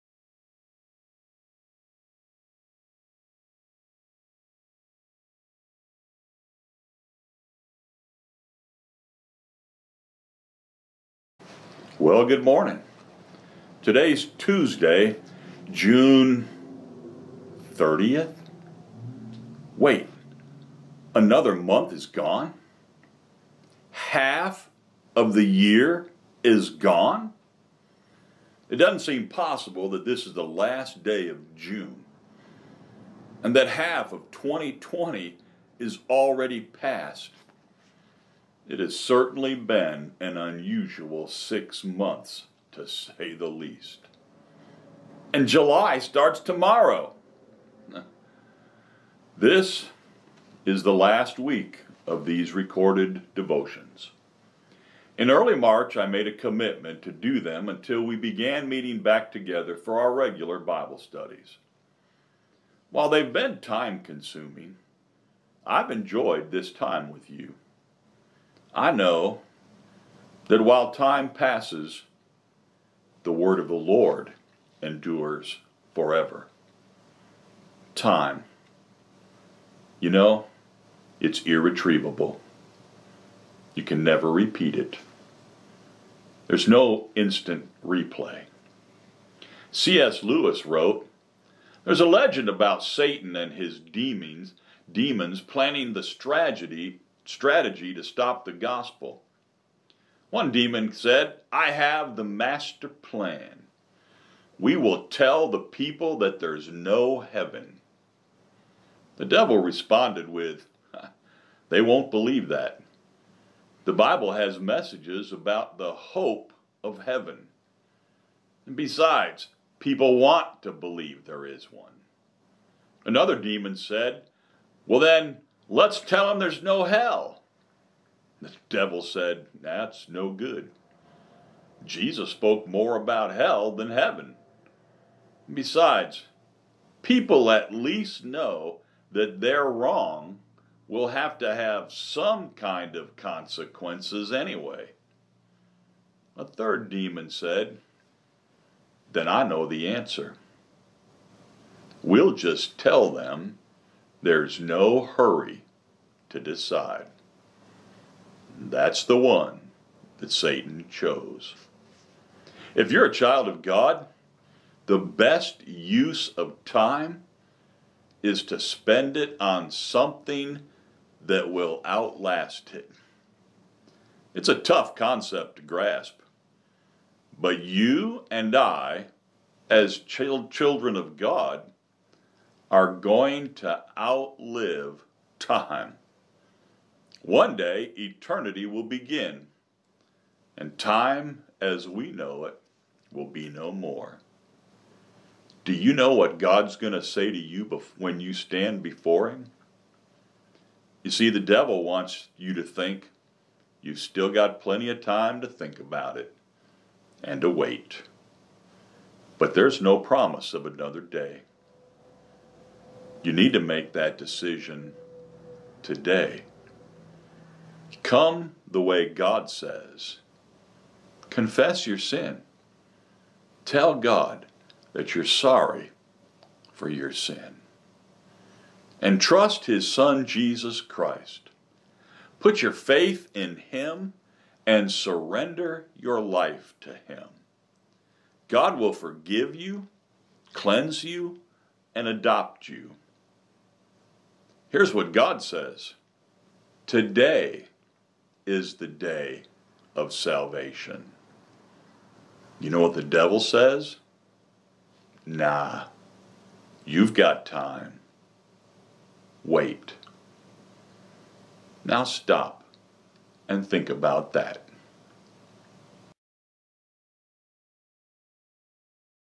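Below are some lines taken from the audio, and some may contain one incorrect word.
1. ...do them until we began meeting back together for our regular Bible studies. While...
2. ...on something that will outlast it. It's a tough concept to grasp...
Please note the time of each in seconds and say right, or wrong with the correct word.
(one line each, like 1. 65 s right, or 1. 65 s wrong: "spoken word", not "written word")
1. 57 s right
2. 169 s right.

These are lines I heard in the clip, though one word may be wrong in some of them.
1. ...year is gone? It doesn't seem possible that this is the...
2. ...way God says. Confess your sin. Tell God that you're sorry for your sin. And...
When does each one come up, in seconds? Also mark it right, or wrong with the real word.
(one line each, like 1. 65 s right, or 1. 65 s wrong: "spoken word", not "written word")
1. 25 s right
2. 218 s right.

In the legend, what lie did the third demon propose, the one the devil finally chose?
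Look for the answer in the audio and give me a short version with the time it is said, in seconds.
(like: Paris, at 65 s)
No hurry to decide, at 154 s.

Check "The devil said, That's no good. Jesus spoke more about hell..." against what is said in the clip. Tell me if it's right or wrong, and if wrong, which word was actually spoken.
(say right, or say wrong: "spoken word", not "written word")
right.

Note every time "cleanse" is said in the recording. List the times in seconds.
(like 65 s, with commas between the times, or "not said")
240 s.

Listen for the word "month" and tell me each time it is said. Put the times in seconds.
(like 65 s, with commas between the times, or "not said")
21 s, 41 s.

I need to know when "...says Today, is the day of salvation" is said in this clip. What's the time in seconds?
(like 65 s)
245 s.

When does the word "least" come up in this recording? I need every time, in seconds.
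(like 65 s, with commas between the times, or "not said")
43 s, 137 s.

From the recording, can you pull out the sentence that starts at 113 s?
The Bible has messages about the hope of heaven.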